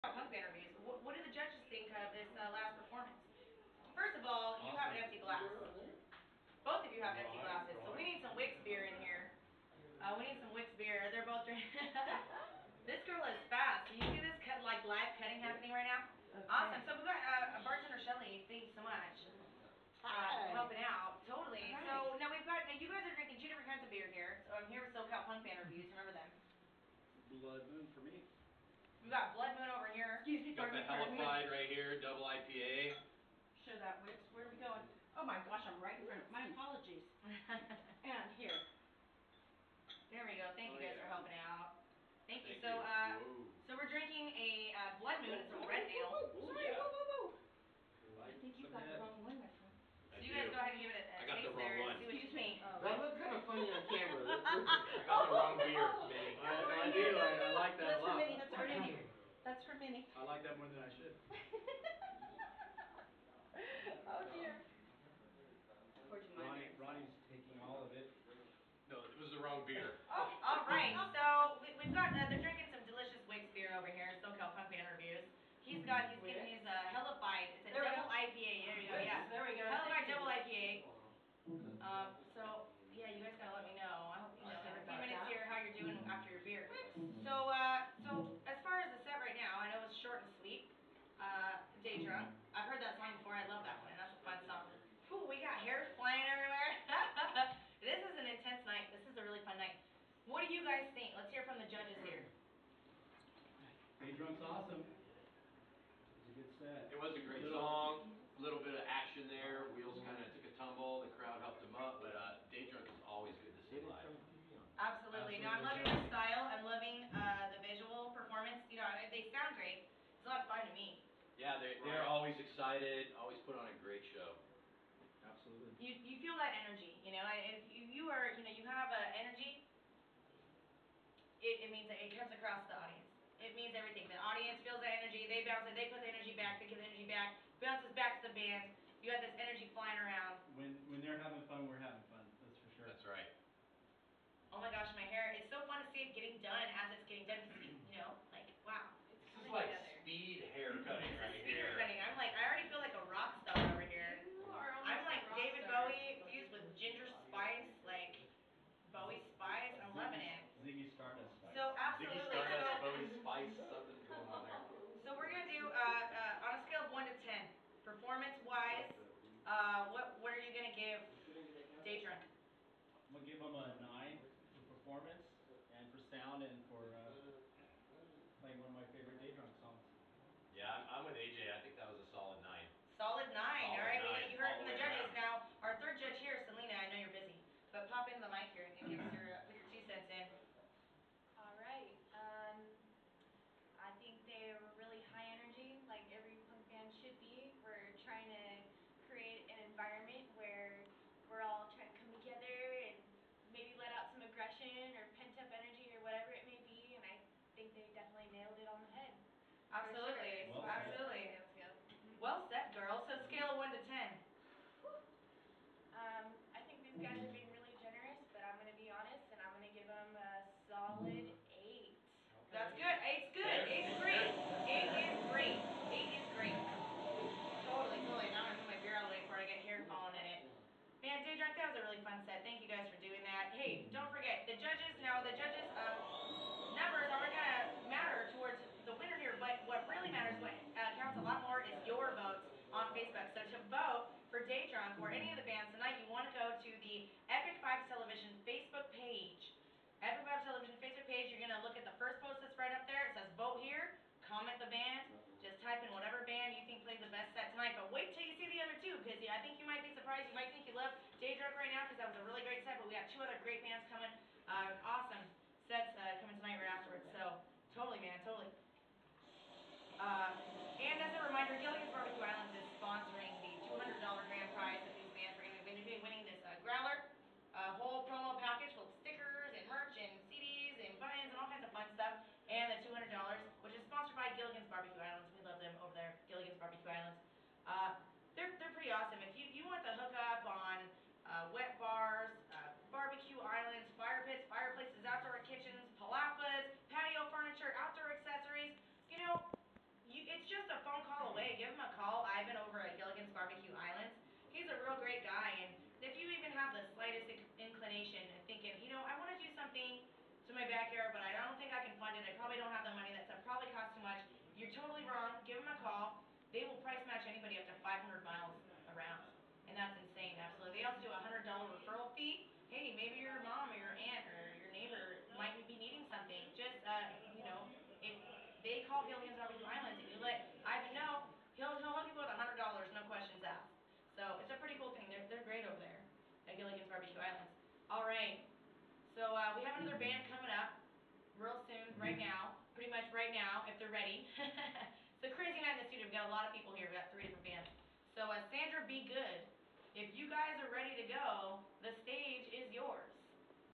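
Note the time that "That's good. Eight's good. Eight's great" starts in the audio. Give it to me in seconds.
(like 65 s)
222 s.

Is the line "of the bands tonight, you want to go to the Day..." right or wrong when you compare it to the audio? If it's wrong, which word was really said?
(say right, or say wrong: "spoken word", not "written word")
wrong: "Epik", not "Day".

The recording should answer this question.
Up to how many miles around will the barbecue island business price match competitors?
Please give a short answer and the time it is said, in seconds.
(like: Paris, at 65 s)
500, at 317 s.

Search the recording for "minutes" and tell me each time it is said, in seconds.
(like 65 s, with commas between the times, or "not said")
85 s.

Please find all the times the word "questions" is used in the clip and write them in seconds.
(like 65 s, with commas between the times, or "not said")
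333 s.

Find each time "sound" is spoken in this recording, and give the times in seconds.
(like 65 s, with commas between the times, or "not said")
119 s, 176 s.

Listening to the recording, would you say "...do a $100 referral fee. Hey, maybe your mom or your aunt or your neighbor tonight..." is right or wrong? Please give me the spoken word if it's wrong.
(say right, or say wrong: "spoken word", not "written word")
wrong: "might", not "tonight".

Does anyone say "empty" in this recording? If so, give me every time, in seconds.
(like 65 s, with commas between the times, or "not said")
7 s.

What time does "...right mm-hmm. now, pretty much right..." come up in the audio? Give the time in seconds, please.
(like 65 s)
342 s.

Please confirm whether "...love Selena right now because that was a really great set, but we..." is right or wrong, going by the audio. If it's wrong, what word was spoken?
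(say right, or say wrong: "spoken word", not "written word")
wrong: "Daydrunk", not "Selena".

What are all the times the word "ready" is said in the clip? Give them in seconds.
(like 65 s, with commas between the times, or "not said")
343 s, 350 s.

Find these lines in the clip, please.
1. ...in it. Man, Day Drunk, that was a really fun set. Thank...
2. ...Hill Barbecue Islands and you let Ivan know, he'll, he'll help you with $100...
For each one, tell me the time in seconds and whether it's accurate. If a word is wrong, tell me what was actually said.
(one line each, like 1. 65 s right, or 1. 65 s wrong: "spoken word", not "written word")
1. 230 s right
2. 329 s right.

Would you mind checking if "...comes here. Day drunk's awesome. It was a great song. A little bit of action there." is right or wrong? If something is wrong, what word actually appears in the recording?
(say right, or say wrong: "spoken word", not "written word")
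wrong: "judges", not "comes".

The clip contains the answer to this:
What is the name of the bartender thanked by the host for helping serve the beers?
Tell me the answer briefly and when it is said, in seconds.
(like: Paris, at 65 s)
Shelly, at 17 s.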